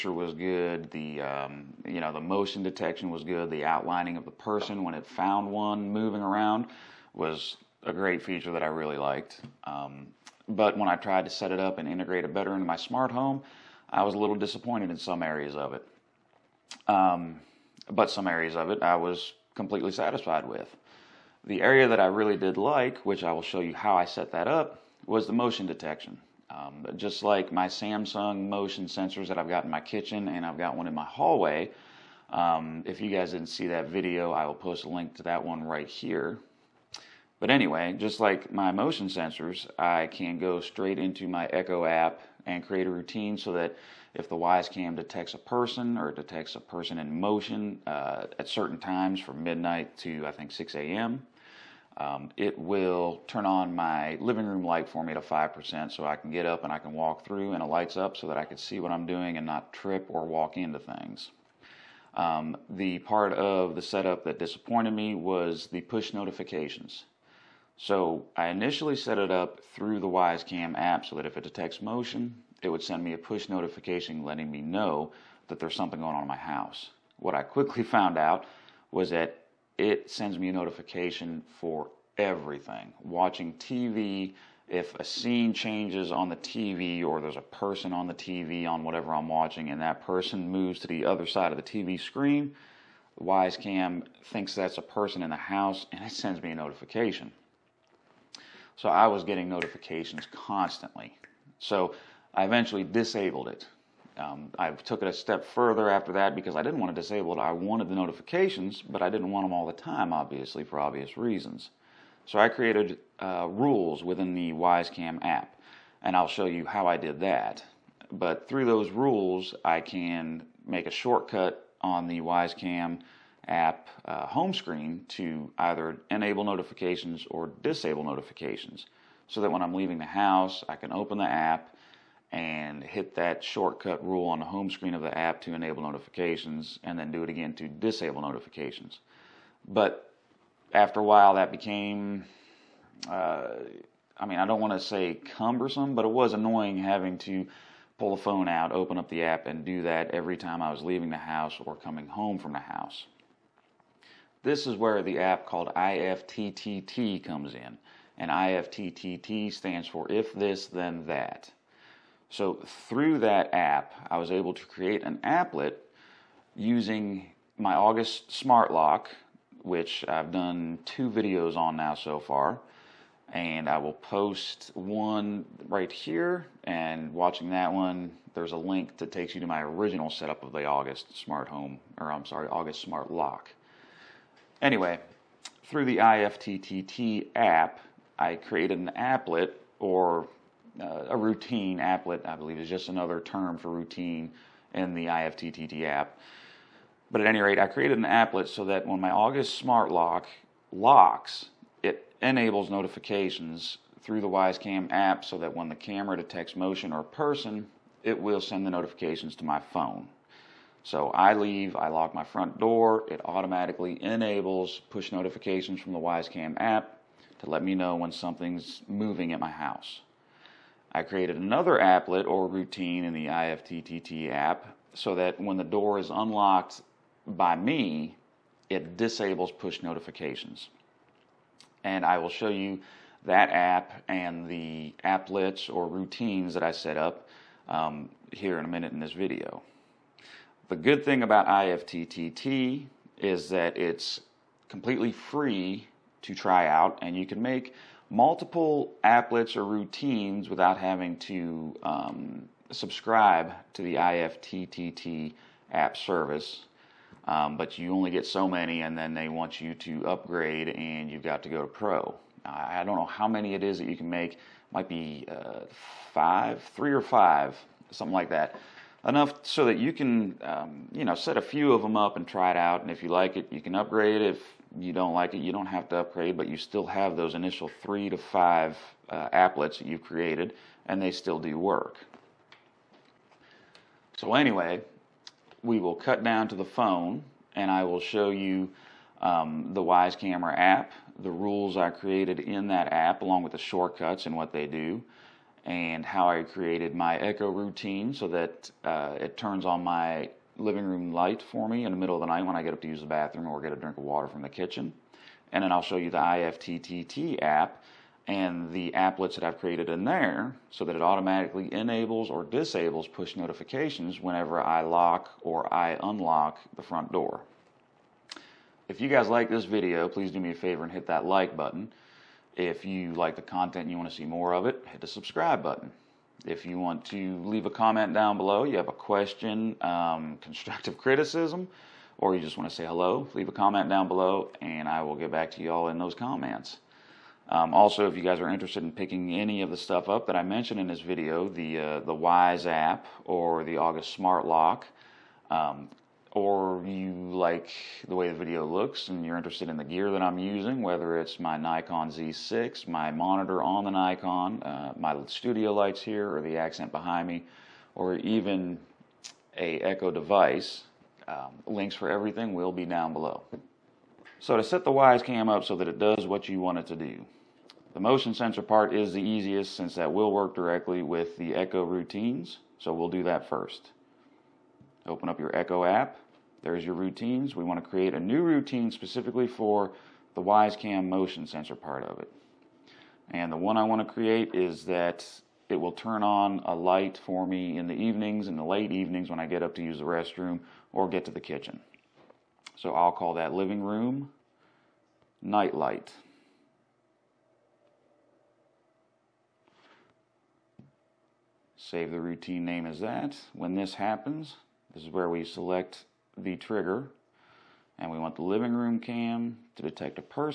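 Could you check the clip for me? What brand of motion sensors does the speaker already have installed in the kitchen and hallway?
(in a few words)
Samsung.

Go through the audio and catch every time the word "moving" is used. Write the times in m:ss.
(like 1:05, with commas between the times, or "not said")
0:05, 3:38.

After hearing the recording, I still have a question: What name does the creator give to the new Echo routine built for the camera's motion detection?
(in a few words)
living room night light.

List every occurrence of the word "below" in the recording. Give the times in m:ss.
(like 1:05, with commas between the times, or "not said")
5:28, 5:34, 6:03.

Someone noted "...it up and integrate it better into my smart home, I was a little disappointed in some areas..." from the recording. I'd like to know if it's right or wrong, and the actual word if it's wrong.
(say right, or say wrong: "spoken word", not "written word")
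right.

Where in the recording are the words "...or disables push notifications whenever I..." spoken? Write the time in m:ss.
5:12.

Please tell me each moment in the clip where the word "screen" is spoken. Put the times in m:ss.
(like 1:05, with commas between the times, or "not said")
1:31, 2:04, 2:14.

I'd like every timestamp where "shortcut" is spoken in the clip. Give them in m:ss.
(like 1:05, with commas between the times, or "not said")
2:00, 2:13, 4:53.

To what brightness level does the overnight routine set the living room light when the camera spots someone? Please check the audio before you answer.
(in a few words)
5%.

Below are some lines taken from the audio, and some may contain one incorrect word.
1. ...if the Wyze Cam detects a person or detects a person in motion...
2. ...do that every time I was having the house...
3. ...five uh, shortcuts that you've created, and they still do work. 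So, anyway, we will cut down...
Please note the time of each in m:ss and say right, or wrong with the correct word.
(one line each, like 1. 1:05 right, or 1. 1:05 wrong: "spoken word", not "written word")
1. 0:44 right
2. 2:29 wrong: "leaving", not "having"
3. 4:38 wrong: "applets", not "shortcuts".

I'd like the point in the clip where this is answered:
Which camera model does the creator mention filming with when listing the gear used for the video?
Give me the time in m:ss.
5:51.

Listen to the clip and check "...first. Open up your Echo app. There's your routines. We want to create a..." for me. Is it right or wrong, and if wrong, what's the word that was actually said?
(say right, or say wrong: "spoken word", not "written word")
right.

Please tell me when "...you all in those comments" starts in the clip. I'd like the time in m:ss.
5:35.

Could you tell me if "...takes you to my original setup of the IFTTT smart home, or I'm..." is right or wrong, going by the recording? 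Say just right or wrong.
wrong.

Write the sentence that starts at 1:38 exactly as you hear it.
So I was getting notifications constantly.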